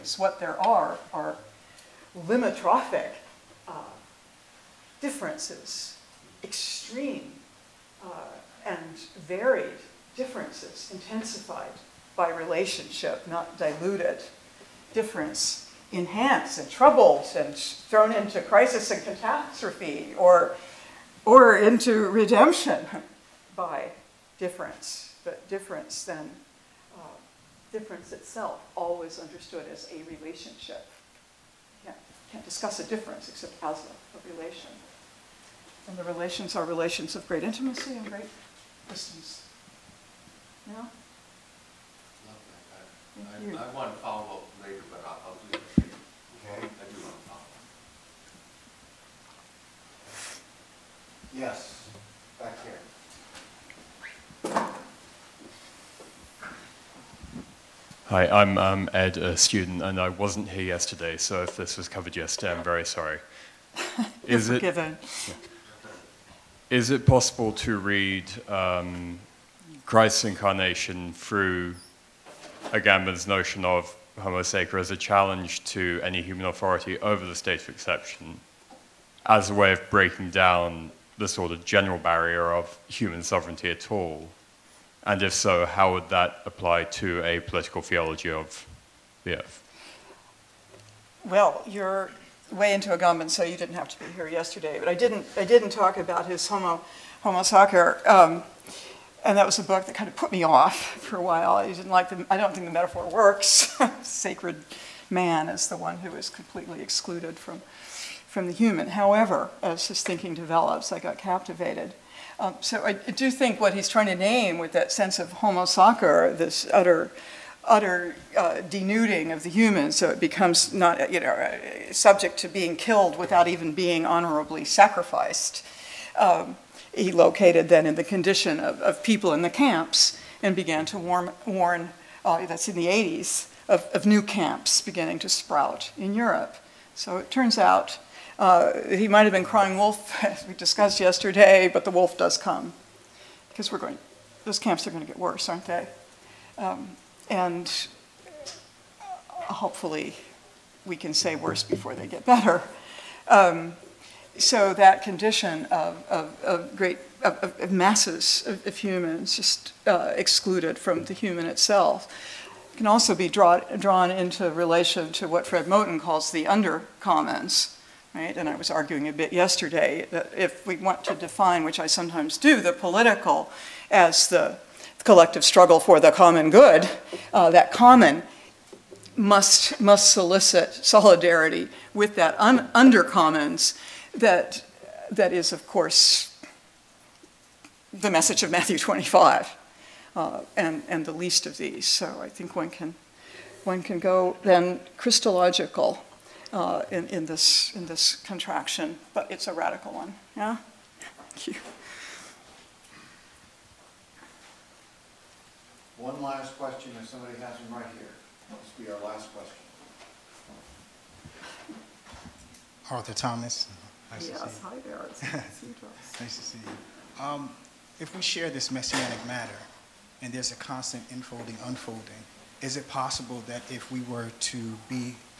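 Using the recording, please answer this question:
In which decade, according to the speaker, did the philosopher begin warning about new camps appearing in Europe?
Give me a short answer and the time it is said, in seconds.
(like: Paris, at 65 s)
the 80s, at 132 s.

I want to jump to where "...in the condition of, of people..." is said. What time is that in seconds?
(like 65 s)
127 s.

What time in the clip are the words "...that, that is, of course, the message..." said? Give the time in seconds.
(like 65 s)
184 s.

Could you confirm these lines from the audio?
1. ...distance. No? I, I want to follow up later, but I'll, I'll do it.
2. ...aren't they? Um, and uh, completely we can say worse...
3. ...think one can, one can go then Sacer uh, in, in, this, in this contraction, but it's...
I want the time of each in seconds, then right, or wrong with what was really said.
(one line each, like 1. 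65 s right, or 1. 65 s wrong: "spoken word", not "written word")
1. 38 s right
2. 145 s wrong: "hopefully", not "completely"
3. 192 s wrong: "Christological", not "Sacer".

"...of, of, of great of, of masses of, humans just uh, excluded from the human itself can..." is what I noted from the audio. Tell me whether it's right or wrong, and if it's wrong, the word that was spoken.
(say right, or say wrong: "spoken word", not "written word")
right.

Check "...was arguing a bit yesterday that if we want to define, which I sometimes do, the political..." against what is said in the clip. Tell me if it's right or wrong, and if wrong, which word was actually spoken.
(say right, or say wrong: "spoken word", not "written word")
right.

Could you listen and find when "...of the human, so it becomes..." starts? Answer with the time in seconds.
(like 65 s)
119 s.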